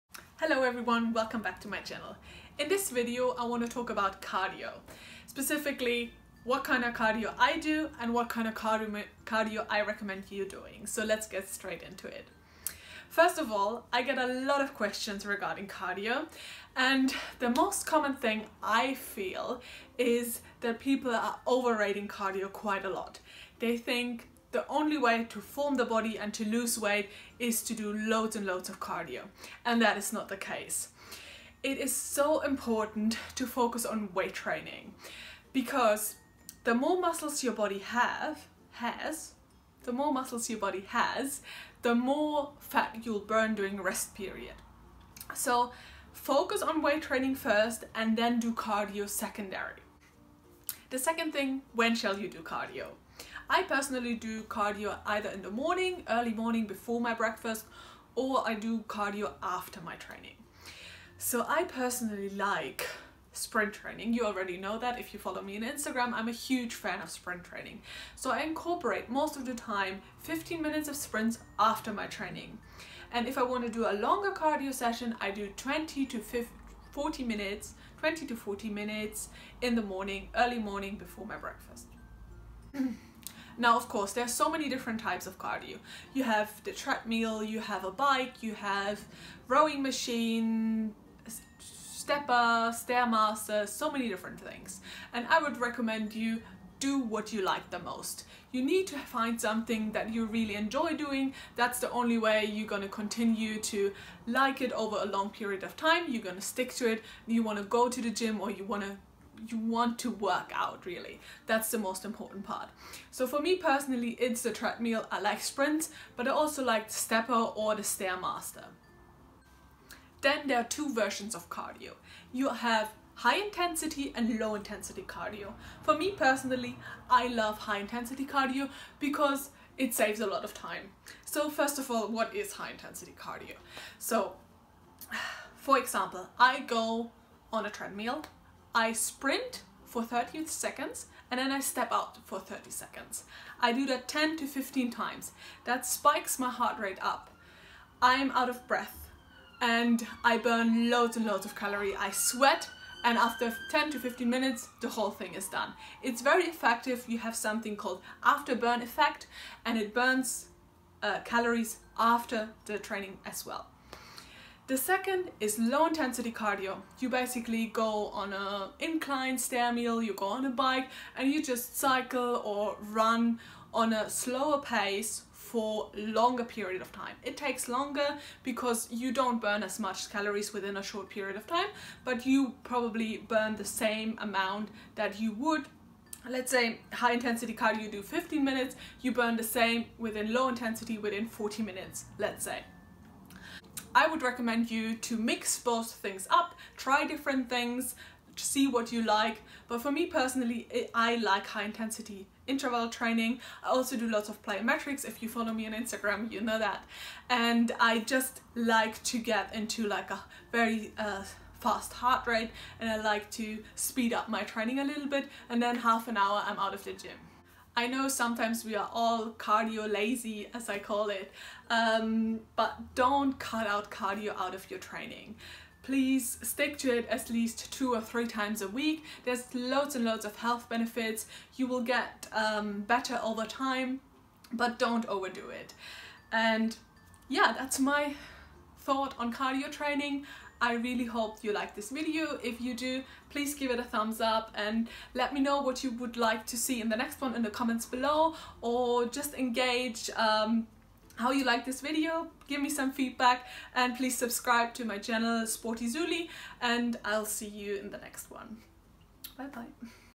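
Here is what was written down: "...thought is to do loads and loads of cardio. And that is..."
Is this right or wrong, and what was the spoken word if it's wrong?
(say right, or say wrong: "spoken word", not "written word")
wrong: "weight", not "thought".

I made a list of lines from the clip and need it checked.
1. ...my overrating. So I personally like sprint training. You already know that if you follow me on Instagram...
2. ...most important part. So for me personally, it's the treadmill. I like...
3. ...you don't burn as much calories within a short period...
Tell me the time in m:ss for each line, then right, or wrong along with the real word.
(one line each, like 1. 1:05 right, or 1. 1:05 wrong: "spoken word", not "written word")
1. 0:59 wrong: "training", not "overrating"
2. 1:51 right
3. 2:58 right.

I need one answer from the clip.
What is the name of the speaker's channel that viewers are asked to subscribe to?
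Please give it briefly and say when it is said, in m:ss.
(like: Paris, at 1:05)
Sporty Suli, at 4:15.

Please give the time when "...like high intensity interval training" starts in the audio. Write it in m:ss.
3:21.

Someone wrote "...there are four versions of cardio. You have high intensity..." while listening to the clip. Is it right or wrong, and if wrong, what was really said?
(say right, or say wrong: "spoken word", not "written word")
wrong: "two", not "four".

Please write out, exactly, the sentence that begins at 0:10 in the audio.
So let's get straight into it.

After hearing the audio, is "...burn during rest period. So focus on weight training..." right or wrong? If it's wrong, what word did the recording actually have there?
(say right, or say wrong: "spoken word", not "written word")
right.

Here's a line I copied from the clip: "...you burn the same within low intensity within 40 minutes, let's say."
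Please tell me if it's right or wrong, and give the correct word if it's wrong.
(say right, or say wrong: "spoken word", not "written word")
right.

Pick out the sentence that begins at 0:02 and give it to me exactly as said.
In this video, I want to talk about cardio.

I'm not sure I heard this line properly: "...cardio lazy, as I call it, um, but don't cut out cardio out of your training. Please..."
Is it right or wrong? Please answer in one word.
right.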